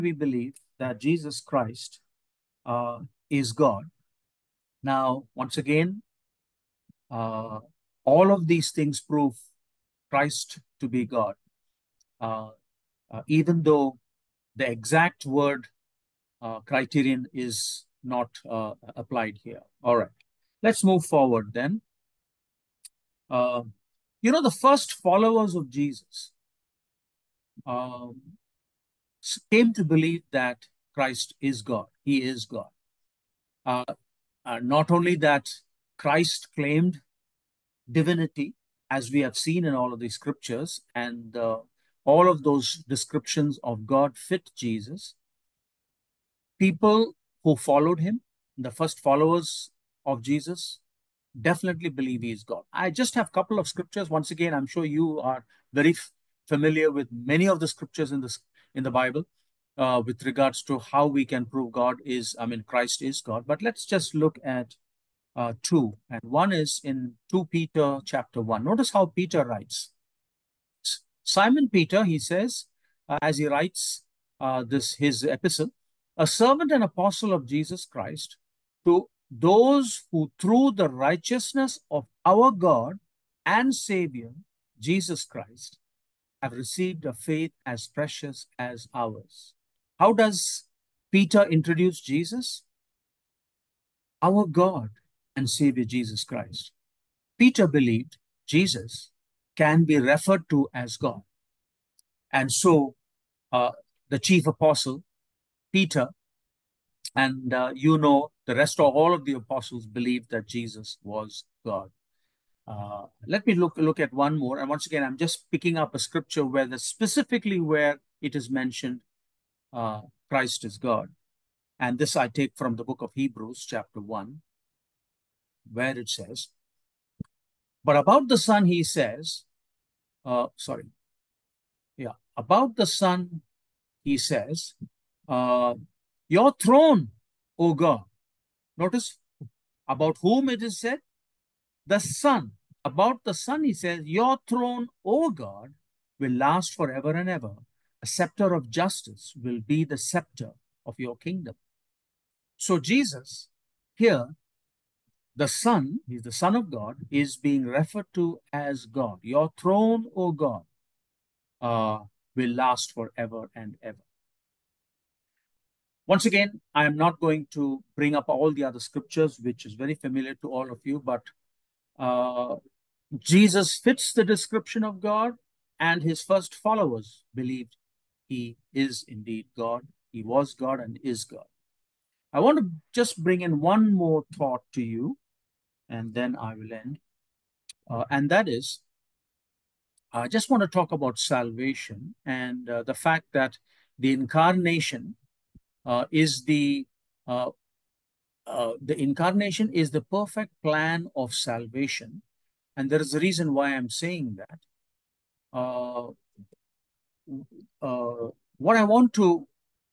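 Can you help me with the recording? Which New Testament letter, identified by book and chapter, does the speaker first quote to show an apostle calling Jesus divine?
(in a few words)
2 Peter 1.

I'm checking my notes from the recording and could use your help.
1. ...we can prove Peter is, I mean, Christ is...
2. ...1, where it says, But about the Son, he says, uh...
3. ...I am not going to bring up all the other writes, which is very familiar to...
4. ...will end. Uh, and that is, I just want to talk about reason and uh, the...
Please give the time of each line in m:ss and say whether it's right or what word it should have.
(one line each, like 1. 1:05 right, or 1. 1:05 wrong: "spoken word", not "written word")
1. 1:01 wrong: "God", not "Peter"
2. 2:03 right
3. 2:46 wrong: "scriptures", not "writes"
4. 3:06 wrong: "salvation", not "reason".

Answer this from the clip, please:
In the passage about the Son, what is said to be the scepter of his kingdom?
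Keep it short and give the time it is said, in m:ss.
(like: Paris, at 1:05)
A scepter of justice, at 2:28.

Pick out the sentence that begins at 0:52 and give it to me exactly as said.
I just have a couple of scriptures.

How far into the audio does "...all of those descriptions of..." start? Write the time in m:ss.
0:42.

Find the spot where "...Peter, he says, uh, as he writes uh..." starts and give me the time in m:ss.
1:11.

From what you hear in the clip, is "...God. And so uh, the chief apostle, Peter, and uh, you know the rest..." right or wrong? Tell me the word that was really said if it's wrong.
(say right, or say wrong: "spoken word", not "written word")
right.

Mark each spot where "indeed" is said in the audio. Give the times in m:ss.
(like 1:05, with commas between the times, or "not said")
2:59.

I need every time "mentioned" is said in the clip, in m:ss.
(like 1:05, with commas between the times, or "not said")
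1:58.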